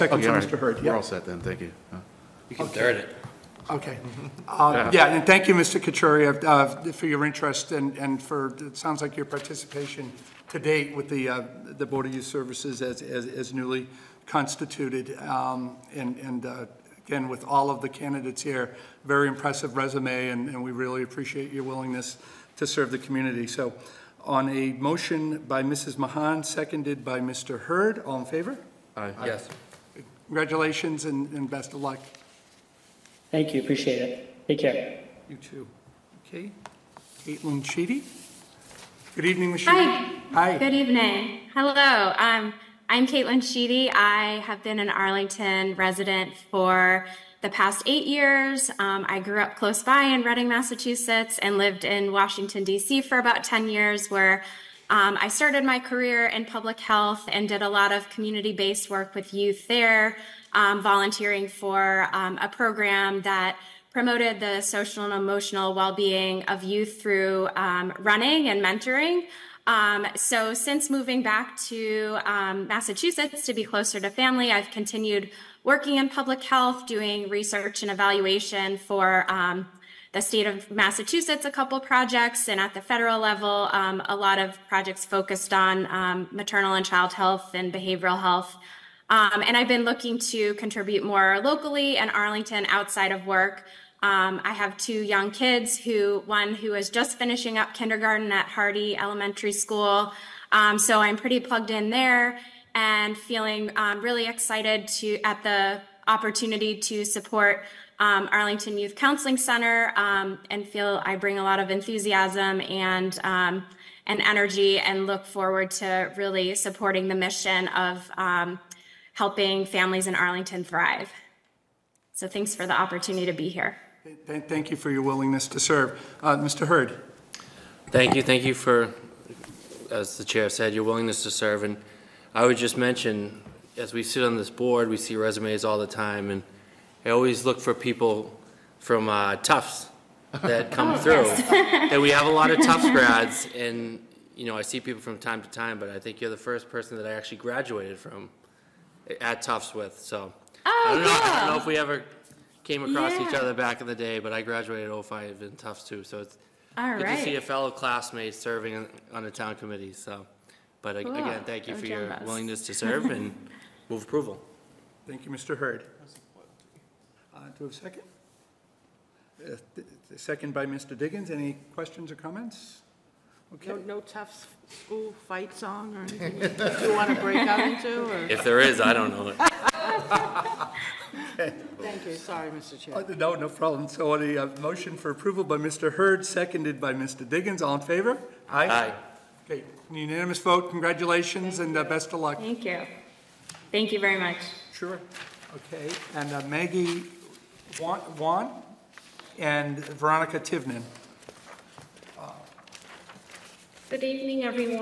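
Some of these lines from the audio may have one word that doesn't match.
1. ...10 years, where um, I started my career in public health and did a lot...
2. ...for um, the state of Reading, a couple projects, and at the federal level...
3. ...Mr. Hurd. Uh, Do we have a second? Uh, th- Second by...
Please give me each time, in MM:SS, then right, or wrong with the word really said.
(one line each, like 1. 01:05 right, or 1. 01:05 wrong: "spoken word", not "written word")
1. 00:53 right
2. 01:18 wrong: "Massachusetts", not "Reading"
3. 02:45 right.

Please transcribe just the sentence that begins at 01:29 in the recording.
Um, and I've been looking to contribute more locally and Arlington outside of work.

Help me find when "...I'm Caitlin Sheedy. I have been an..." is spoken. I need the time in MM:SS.
00:42.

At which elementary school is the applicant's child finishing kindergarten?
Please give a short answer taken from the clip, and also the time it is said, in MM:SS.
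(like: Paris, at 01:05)
Hardy Elementary School, at 01:38.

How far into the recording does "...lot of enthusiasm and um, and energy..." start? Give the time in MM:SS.
01:51.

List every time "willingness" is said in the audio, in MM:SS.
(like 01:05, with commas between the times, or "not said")
00:21, 02:05, 02:10, 02:42.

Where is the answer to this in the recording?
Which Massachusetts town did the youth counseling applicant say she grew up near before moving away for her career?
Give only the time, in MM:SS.
00:50.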